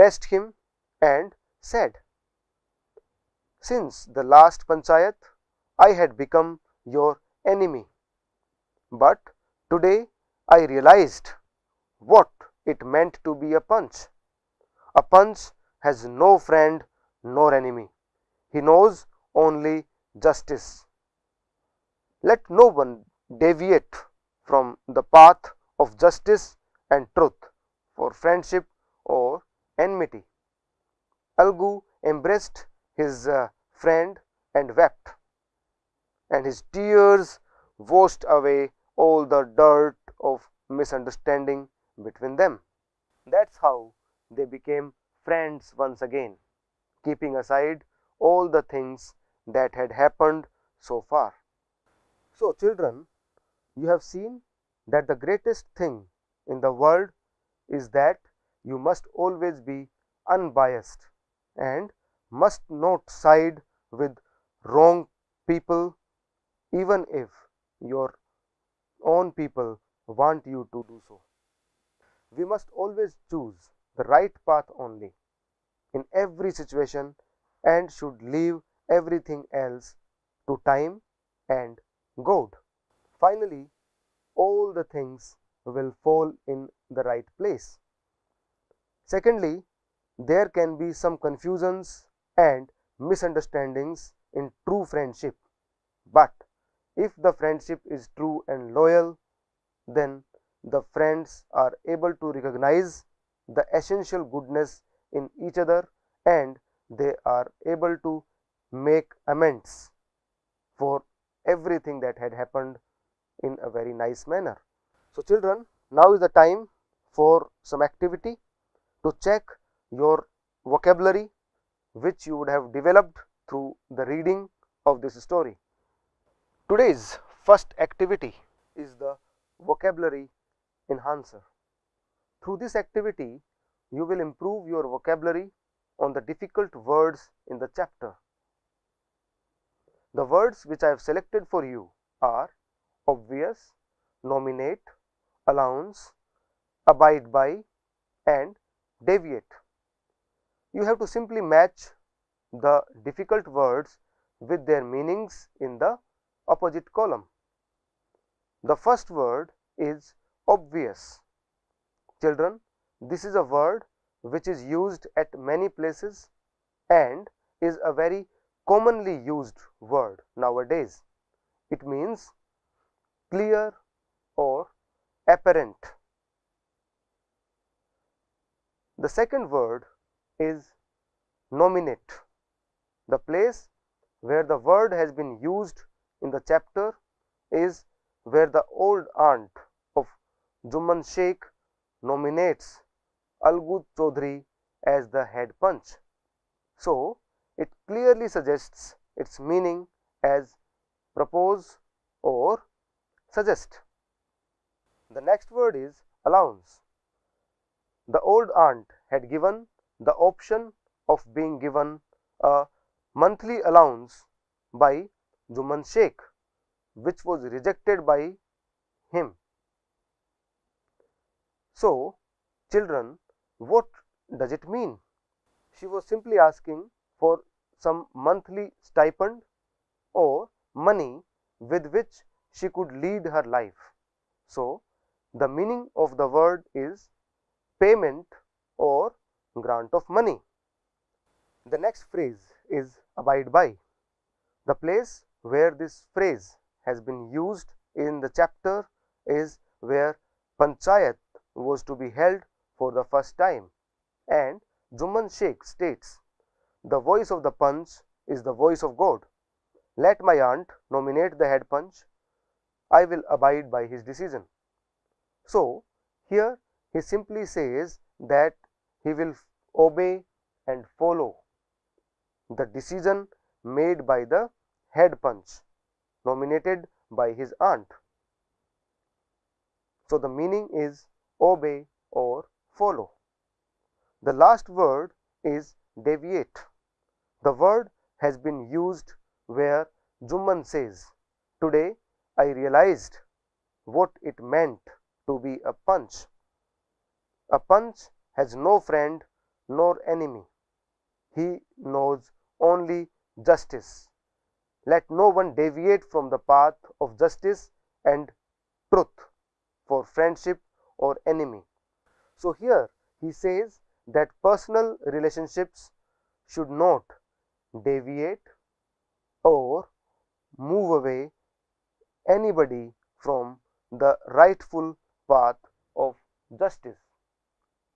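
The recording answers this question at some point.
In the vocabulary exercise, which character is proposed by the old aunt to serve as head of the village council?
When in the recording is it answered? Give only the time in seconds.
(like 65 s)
193 s.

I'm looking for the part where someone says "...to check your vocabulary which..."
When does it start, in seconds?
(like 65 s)
119 s.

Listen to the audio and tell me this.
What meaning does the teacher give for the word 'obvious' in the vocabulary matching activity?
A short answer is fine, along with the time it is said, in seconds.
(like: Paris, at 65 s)
clear or apparent, at 173 s.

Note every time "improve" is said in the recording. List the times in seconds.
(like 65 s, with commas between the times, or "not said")
134 s.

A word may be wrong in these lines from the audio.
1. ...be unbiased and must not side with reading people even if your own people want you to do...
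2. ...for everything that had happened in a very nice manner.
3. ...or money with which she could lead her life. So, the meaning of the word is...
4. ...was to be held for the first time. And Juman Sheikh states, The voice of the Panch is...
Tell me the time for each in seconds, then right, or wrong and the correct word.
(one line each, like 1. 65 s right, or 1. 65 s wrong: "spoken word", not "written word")
1. 59 s wrong: "wrong", not "reading"
2. 110 s right
3. 230 s right
4. 251 s right.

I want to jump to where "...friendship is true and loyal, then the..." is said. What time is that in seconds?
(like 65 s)
97 s.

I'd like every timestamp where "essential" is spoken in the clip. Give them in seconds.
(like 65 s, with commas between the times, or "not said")
103 s.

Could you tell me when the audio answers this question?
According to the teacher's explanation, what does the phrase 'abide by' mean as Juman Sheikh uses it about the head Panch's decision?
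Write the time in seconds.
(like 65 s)
281 s.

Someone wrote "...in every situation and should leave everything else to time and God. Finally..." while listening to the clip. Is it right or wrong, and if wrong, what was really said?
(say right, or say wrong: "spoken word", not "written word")
right.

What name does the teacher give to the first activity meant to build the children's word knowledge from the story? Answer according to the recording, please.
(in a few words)
vocabulary enhancer.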